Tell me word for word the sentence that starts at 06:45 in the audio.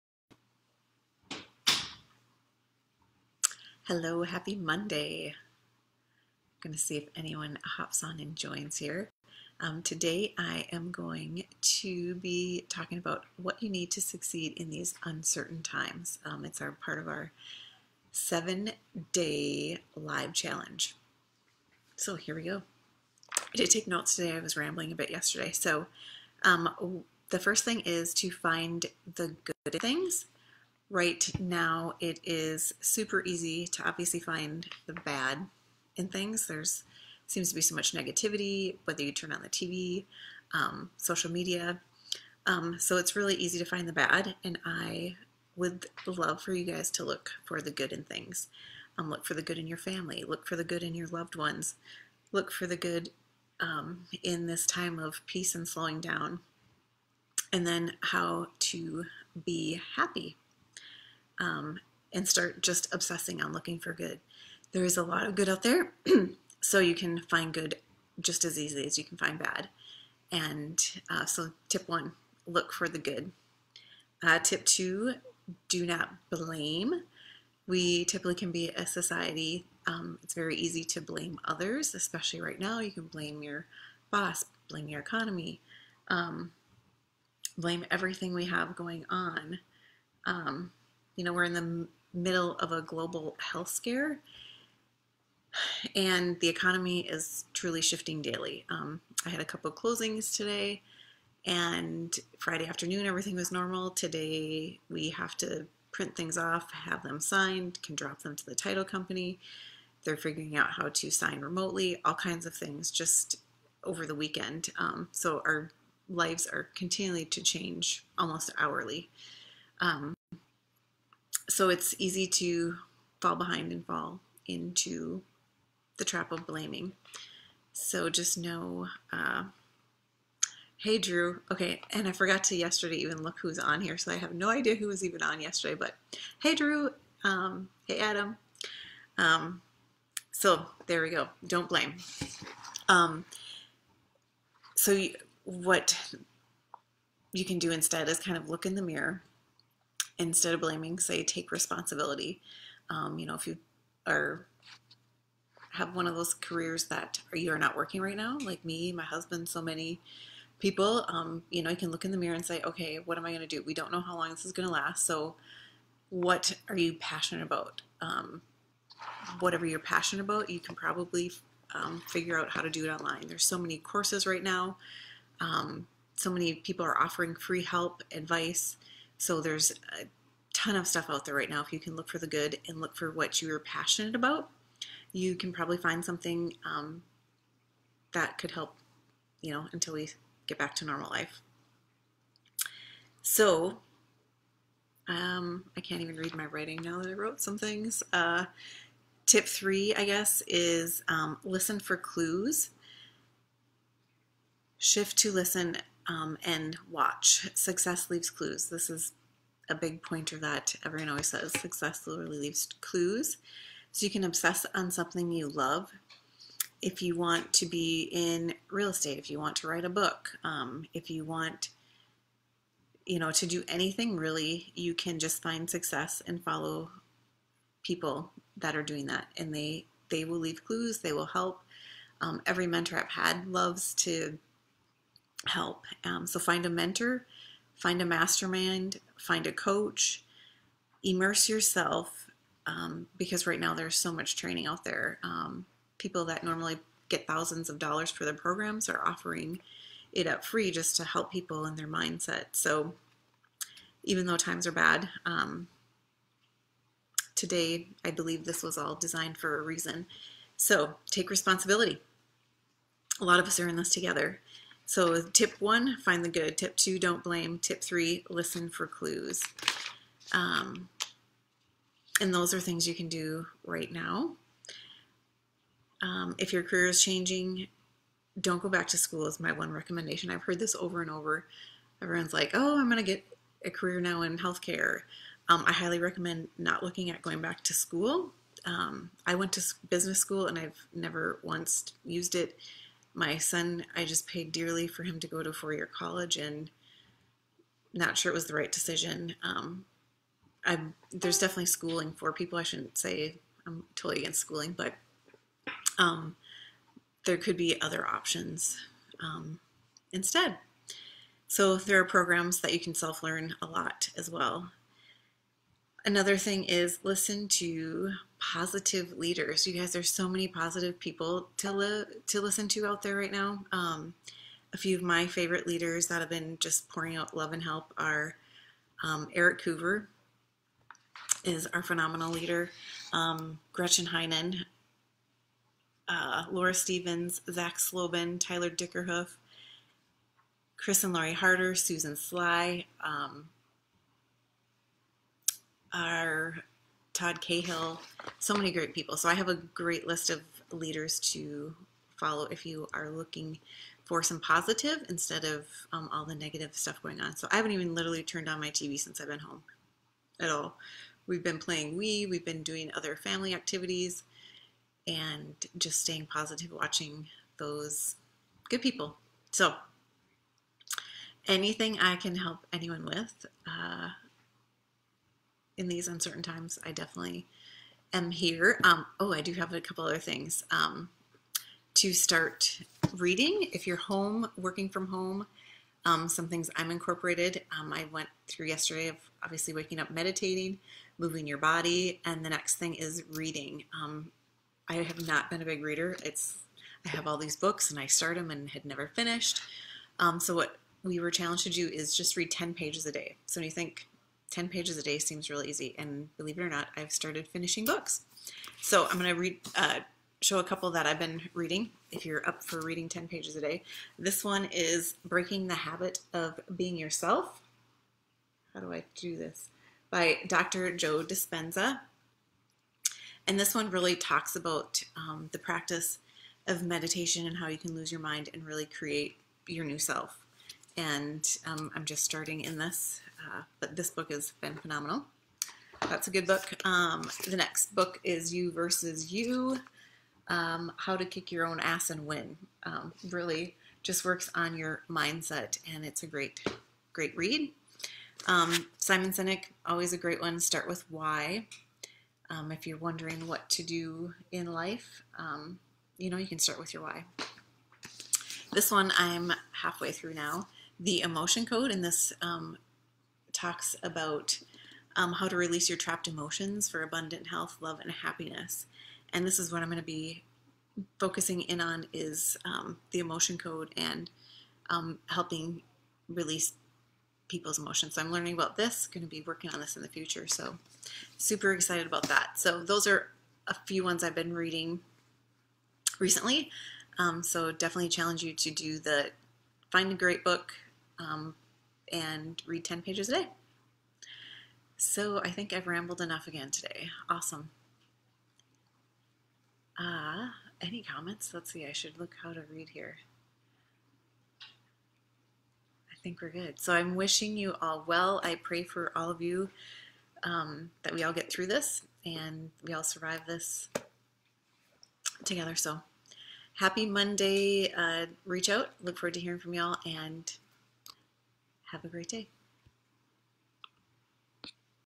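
And believe it or not, I've started finishing books.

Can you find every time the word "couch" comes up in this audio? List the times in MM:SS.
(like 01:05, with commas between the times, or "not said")
not said.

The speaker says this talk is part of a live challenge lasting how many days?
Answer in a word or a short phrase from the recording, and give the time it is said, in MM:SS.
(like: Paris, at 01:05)
7, at 00:18.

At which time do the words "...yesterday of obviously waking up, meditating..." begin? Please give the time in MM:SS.
06:28.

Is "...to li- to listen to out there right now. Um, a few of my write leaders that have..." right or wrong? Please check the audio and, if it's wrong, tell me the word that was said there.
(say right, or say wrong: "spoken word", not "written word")
wrong: "favorite", not "write".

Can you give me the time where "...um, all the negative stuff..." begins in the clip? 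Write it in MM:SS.
05:55.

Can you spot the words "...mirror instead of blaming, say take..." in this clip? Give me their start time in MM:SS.
02:28.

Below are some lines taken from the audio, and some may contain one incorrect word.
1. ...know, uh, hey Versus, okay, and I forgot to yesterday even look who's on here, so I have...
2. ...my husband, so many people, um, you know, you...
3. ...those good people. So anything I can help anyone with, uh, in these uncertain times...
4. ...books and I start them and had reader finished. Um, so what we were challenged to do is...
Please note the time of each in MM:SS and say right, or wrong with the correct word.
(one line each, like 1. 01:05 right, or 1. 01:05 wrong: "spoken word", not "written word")
1. 02:08 wrong: "Drew", not "Versus"
2. 02:38 right
3. 06:07 right
4. 06:37 wrong: "never", not "reader".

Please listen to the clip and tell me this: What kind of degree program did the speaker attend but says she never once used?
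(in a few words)
business school.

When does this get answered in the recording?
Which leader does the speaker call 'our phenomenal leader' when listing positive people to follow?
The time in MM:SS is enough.
05:29.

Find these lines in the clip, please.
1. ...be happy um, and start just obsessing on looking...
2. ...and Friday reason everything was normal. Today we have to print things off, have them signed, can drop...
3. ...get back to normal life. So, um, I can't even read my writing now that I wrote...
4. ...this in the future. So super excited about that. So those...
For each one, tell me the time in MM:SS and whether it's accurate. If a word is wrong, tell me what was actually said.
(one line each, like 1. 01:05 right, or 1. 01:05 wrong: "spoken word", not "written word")
1. 00:59 right
2. 01:41 wrong: "afternoon", not "reason"
3. 03:10 right
4. 07:59 right.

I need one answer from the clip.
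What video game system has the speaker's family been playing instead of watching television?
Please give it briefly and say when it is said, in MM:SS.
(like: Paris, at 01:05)
Wii, at 06:01.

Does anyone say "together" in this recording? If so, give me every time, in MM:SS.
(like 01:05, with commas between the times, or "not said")
04:23, 08:35.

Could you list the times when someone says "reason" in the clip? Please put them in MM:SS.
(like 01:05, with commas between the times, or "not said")
04:19.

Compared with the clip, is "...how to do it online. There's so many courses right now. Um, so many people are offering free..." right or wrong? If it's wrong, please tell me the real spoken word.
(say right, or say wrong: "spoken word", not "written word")
right.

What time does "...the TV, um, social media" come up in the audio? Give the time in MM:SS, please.
00:39.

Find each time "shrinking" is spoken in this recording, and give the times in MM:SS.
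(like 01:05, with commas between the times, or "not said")
not said.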